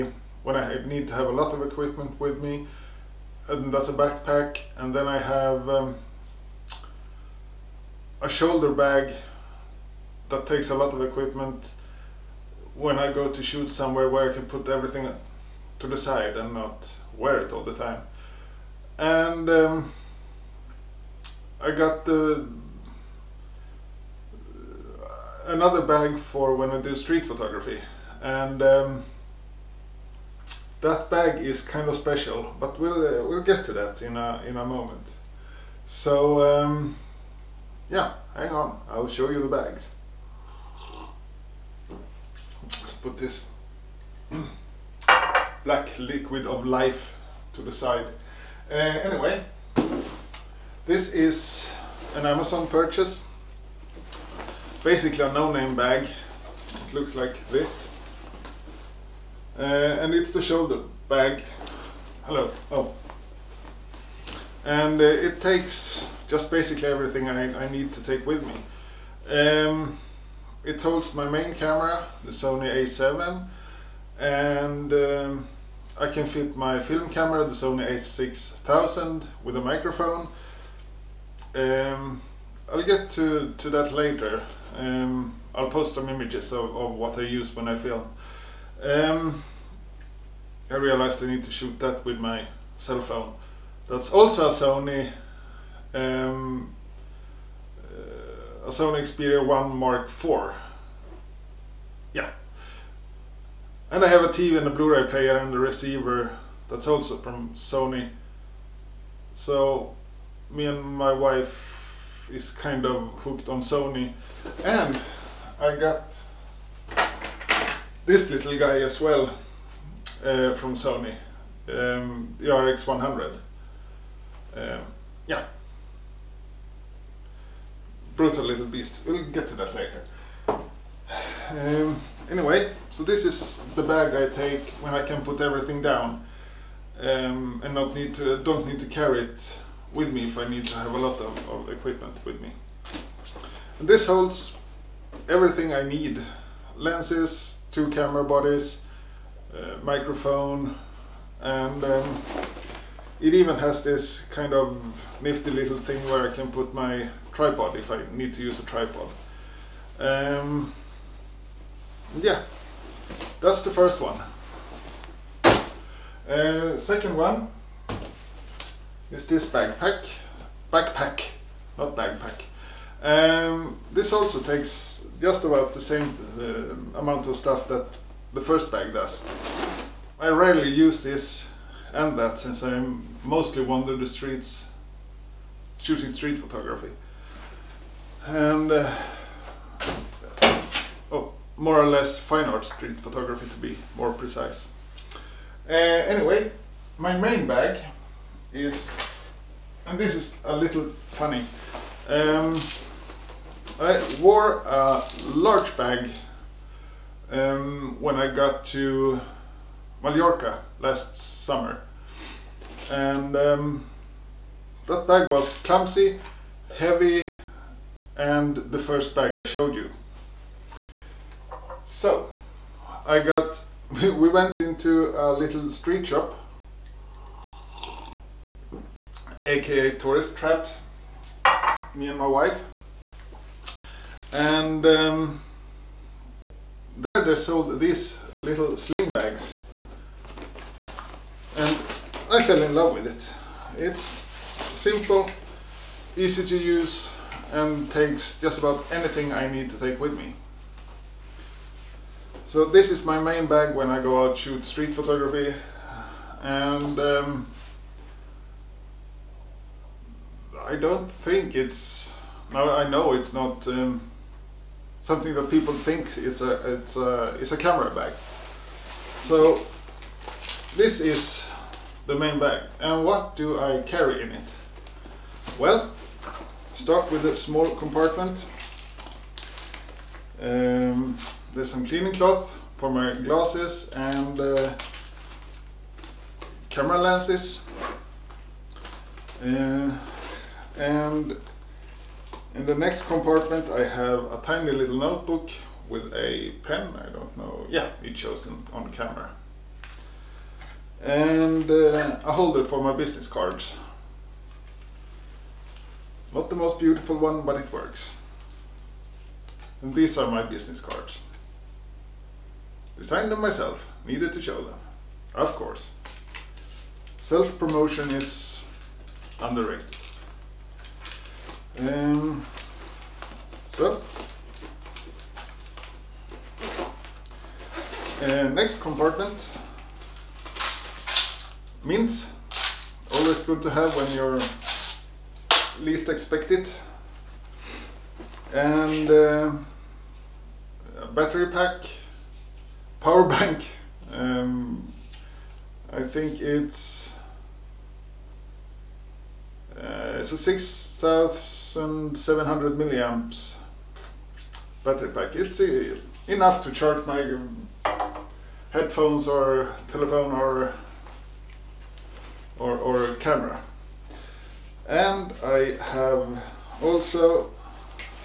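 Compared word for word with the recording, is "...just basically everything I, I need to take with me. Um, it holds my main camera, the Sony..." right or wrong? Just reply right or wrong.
right.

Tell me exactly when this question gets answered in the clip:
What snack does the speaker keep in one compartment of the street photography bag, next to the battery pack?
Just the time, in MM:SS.
05:31.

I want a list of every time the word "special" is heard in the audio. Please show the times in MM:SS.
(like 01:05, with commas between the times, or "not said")
00:31.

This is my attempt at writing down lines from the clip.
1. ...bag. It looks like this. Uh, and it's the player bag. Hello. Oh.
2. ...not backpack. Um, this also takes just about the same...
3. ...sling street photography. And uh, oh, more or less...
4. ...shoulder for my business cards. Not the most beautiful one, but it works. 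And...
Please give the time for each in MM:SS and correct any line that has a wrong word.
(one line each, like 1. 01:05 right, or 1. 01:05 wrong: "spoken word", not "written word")
1. 00:55 wrong: "shoulder", not "player"
2. 02:51 right
3. 03:05 wrong: "shooting", not "sling"
4. 05:02 wrong: "holder", not "shoulder".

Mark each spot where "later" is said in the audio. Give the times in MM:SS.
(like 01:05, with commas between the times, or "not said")
01:23, 02:09.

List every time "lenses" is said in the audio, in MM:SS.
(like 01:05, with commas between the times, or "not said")
02:26, 04:46.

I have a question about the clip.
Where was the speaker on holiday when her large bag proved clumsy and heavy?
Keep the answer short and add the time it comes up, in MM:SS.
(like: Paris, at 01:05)
Mallorca, at 03:30.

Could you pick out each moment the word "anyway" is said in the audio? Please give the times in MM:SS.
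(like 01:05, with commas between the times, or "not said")
00:48, 02:12, 03:16.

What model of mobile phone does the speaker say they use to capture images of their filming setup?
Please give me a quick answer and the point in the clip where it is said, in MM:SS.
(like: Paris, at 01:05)
Sony Xperia 1 Mark IV, at 01:38.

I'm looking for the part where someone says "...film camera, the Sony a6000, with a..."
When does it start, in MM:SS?
01:16.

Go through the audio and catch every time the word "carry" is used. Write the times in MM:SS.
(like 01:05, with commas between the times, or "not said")
02:18, 04:33.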